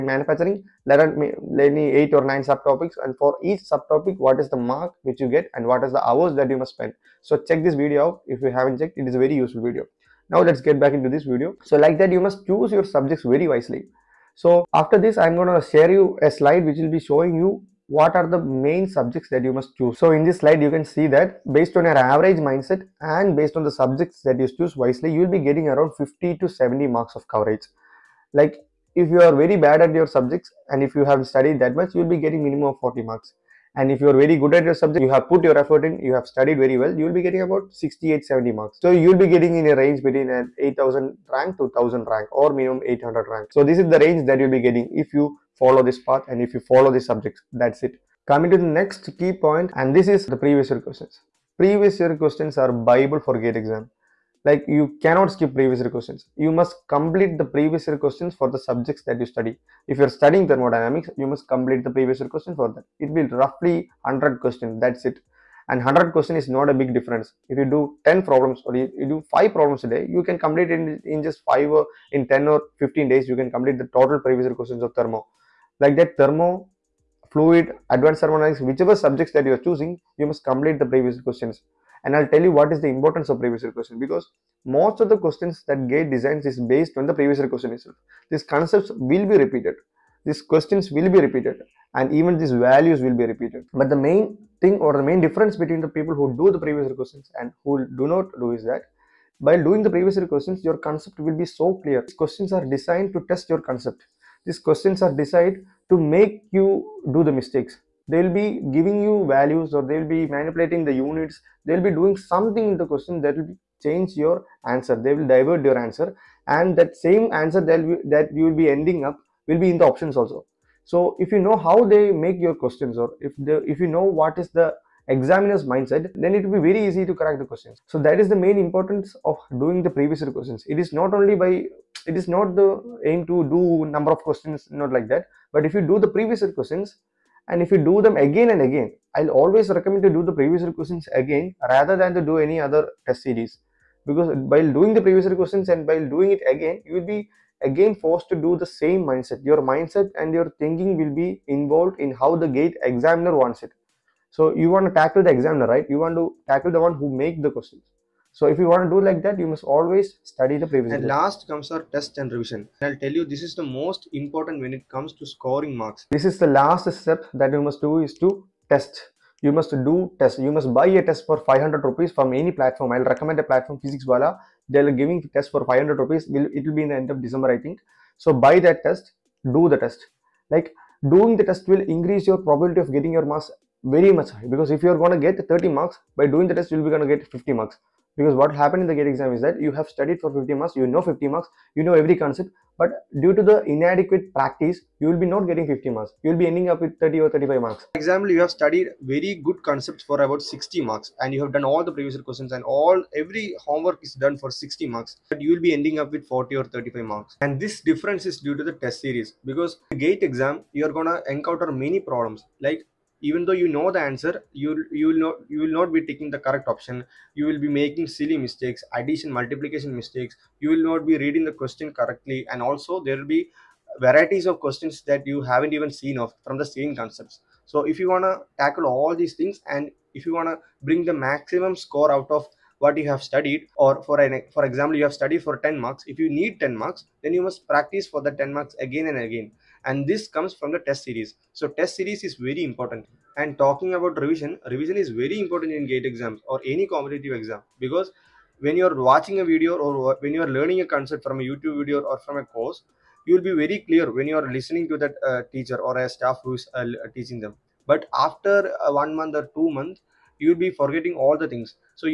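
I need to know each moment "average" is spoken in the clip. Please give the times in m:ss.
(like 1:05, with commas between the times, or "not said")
0:21.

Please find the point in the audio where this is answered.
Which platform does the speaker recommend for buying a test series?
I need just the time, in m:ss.
2:53.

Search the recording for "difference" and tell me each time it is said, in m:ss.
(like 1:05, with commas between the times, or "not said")
1:06, 1:35, 3:27.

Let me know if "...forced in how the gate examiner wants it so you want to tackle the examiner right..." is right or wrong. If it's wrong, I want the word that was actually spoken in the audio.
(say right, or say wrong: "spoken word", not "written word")
wrong: "involved", not "forced".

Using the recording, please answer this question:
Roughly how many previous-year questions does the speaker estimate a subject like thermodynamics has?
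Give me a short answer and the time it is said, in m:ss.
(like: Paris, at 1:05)
100, at 1:03.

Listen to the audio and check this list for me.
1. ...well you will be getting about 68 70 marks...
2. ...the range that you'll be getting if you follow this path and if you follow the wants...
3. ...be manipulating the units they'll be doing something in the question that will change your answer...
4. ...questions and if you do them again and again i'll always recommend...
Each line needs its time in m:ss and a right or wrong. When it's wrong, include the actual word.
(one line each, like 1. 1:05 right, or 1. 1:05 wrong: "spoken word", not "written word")
1. 0:36 right
2. 0:43 wrong: "subjects", not "wants"
3. 1:50 right
4. 2:16 right.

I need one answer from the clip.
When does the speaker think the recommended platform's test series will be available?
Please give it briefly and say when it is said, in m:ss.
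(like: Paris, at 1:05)
end of December, at 2:56.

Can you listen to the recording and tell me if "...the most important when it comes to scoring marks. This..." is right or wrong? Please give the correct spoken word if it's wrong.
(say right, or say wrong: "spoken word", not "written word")
right.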